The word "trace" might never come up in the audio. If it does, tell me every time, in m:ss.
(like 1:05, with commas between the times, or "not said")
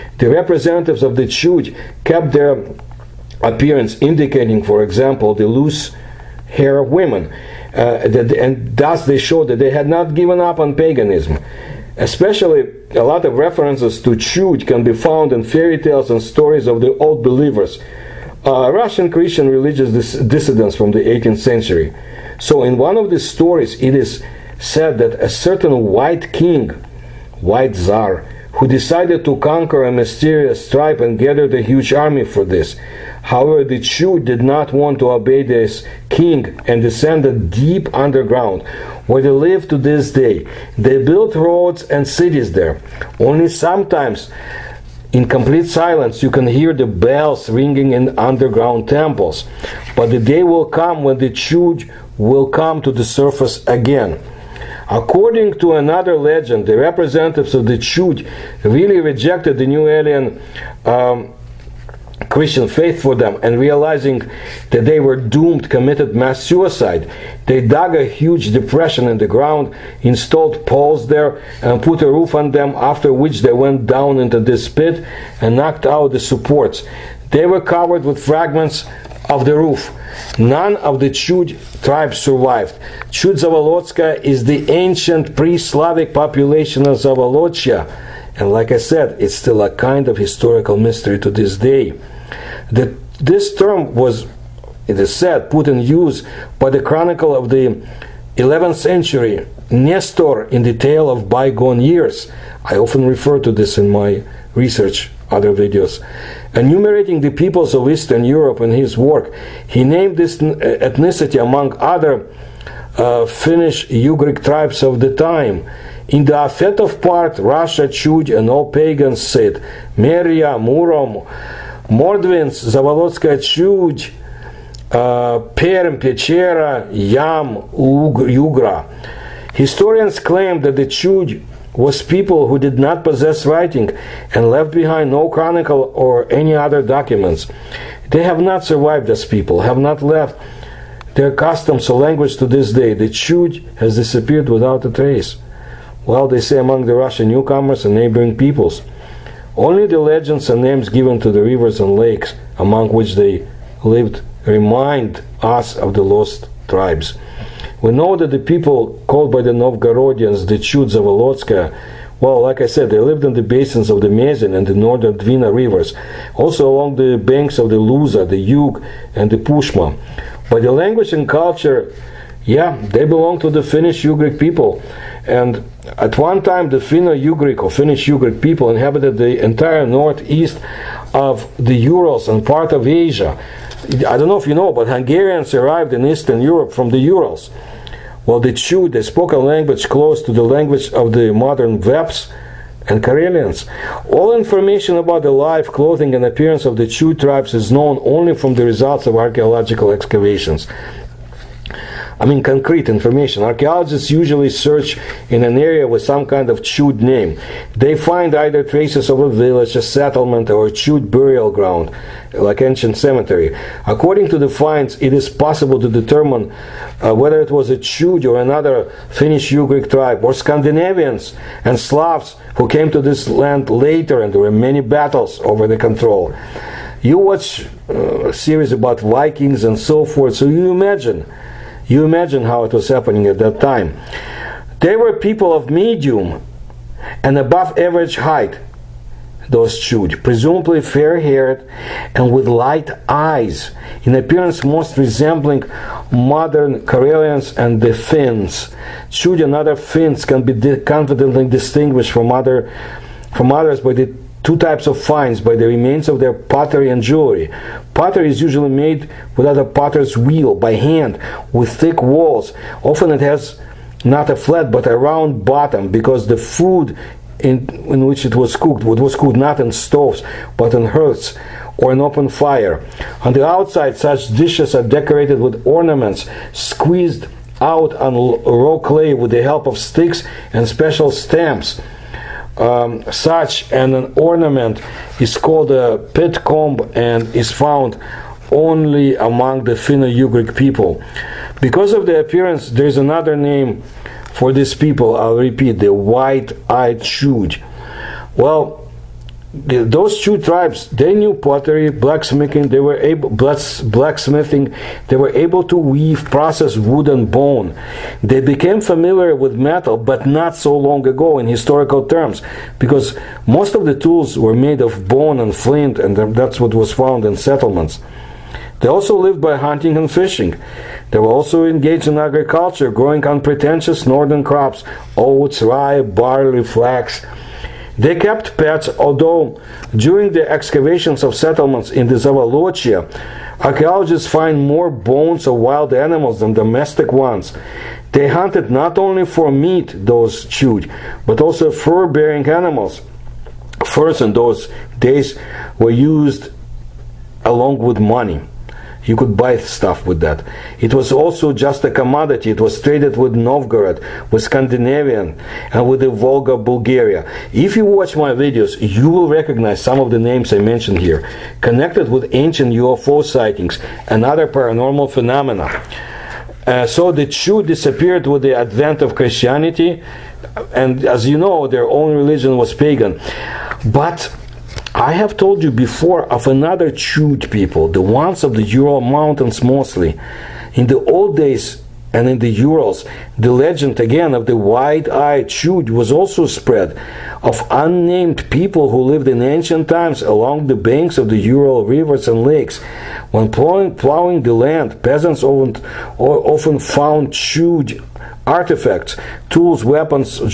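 2:24, 3:28.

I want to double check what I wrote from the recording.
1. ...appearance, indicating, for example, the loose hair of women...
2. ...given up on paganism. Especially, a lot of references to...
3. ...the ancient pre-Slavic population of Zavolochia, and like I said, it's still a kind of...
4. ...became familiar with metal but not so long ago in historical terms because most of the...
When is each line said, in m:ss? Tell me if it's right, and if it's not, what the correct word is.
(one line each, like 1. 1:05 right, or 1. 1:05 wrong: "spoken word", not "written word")
1. 0:03 right
2. 0:10 right
3. 1:24 right
4. 5:08 right.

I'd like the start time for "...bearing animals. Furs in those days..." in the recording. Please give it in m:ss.
5:42.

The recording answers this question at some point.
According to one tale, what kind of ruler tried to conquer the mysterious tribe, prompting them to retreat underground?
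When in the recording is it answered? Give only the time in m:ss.
0:27.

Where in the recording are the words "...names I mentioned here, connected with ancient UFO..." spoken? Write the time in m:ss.
6:00.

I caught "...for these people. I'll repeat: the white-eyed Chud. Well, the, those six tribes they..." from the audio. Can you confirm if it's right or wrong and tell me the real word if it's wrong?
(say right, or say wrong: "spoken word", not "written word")
wrong: "two", not "six".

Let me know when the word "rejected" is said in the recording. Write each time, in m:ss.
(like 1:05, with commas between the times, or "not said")
0:59.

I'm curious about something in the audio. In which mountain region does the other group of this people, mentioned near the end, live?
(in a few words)
Ural Mountains.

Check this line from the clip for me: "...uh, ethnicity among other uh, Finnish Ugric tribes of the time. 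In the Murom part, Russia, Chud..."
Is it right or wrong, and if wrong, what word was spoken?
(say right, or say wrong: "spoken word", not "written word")
wrong: "Afetov", not "Murom".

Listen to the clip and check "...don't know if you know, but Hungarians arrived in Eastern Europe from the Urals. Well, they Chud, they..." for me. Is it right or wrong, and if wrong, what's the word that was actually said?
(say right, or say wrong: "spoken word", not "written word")
right.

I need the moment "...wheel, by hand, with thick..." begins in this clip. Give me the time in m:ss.
4:20.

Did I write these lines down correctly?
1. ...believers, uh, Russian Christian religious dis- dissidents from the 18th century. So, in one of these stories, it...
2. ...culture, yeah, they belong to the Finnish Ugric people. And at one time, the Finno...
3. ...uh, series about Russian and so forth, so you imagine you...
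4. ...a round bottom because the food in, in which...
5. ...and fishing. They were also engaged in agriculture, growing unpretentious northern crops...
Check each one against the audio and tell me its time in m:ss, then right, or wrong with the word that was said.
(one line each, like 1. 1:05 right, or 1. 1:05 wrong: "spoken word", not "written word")
1. 0:17 right
2. 2:51 right
3. 3:47 wrong: "Vikings", not "Russian"
4. 4:24 right
5. 5:19 right.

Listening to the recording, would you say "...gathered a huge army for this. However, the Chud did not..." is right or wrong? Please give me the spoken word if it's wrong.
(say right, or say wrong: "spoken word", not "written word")
right.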